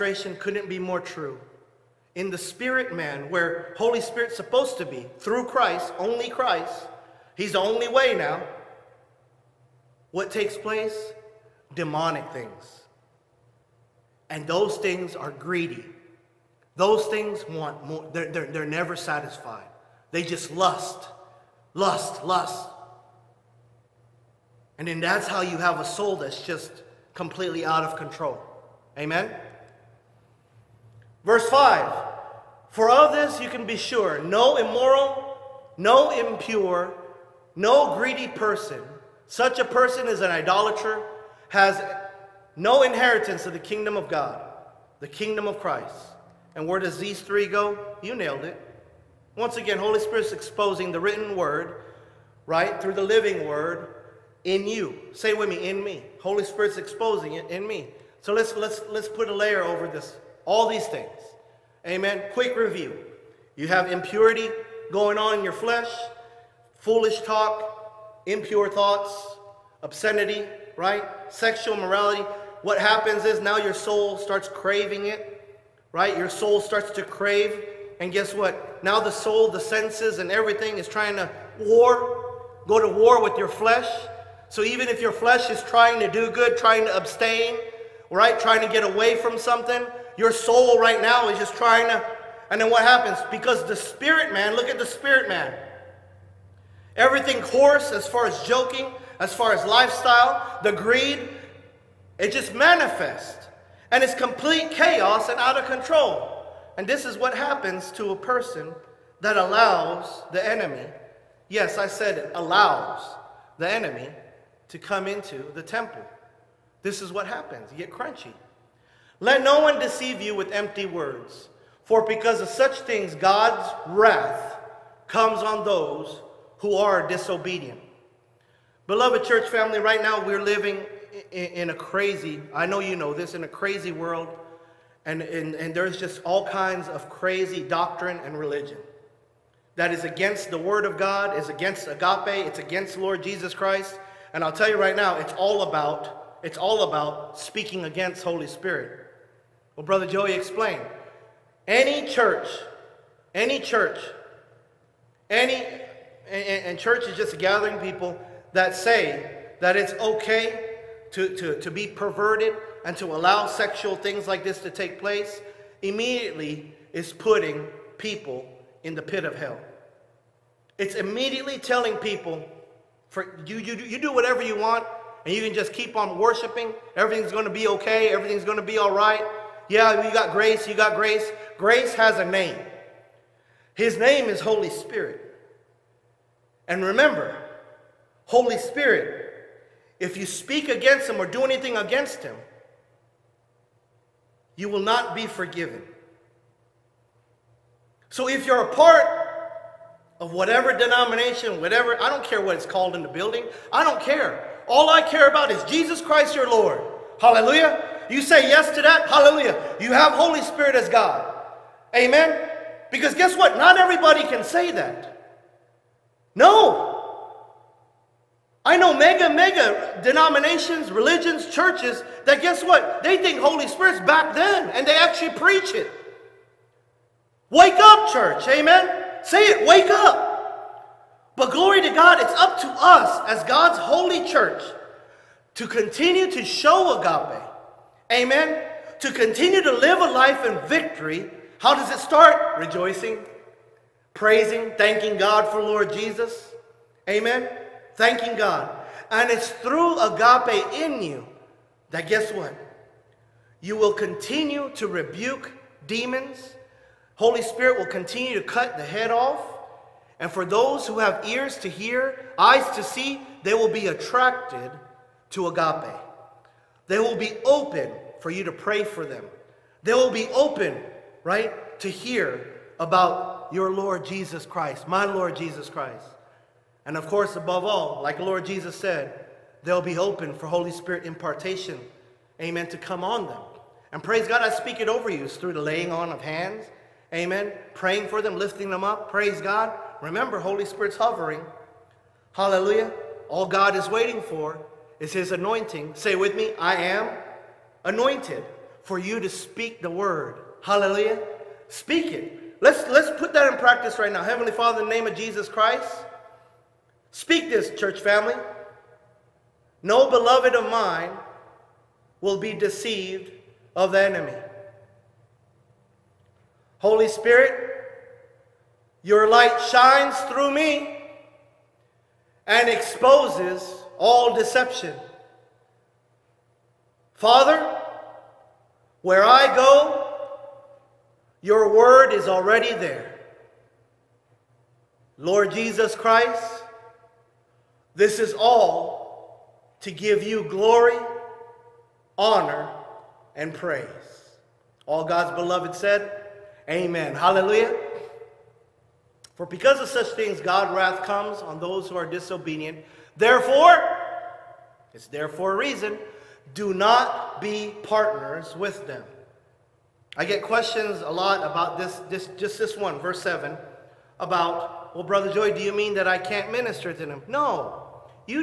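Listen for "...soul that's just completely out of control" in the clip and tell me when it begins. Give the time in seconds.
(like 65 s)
25 s.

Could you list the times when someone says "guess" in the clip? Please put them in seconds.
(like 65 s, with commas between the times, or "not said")
78 s, 213 s, 222 s, 252 s.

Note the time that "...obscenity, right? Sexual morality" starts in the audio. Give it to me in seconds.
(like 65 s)
69 s.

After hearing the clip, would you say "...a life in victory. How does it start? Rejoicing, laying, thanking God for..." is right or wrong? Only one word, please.
wrong.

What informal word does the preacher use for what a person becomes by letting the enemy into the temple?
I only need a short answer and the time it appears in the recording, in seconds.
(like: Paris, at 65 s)
Crunchy, at 117 s.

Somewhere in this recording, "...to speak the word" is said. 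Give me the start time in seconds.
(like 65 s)
299 s.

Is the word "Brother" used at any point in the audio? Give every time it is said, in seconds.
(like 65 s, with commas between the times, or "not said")
149 s, 365 s.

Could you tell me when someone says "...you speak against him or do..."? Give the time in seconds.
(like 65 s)
190 s.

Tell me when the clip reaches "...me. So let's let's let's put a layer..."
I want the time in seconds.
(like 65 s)
57 s.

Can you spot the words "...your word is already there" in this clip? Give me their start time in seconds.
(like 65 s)
331 s.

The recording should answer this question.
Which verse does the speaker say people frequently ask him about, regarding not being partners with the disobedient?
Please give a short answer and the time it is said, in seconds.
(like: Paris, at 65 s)
Verse 7, at 362 s.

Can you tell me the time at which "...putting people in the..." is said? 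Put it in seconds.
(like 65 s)
167 s.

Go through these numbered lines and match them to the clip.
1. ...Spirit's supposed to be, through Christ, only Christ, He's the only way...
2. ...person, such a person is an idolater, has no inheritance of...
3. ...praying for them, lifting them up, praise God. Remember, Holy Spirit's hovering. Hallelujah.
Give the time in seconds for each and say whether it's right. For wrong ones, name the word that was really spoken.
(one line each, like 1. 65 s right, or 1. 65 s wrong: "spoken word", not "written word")
1. 4 s right
2. 38 s right
3. 287 s right.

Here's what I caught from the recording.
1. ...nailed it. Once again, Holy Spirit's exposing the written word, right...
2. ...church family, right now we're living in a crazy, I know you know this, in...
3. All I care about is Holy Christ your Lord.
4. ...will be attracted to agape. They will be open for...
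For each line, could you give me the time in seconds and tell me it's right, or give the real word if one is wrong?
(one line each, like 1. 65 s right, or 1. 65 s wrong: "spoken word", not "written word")
1. 48 s right
2. 129 s right
3. 204 s wrong: "Jesus", not "Holy"
4. 263 s right.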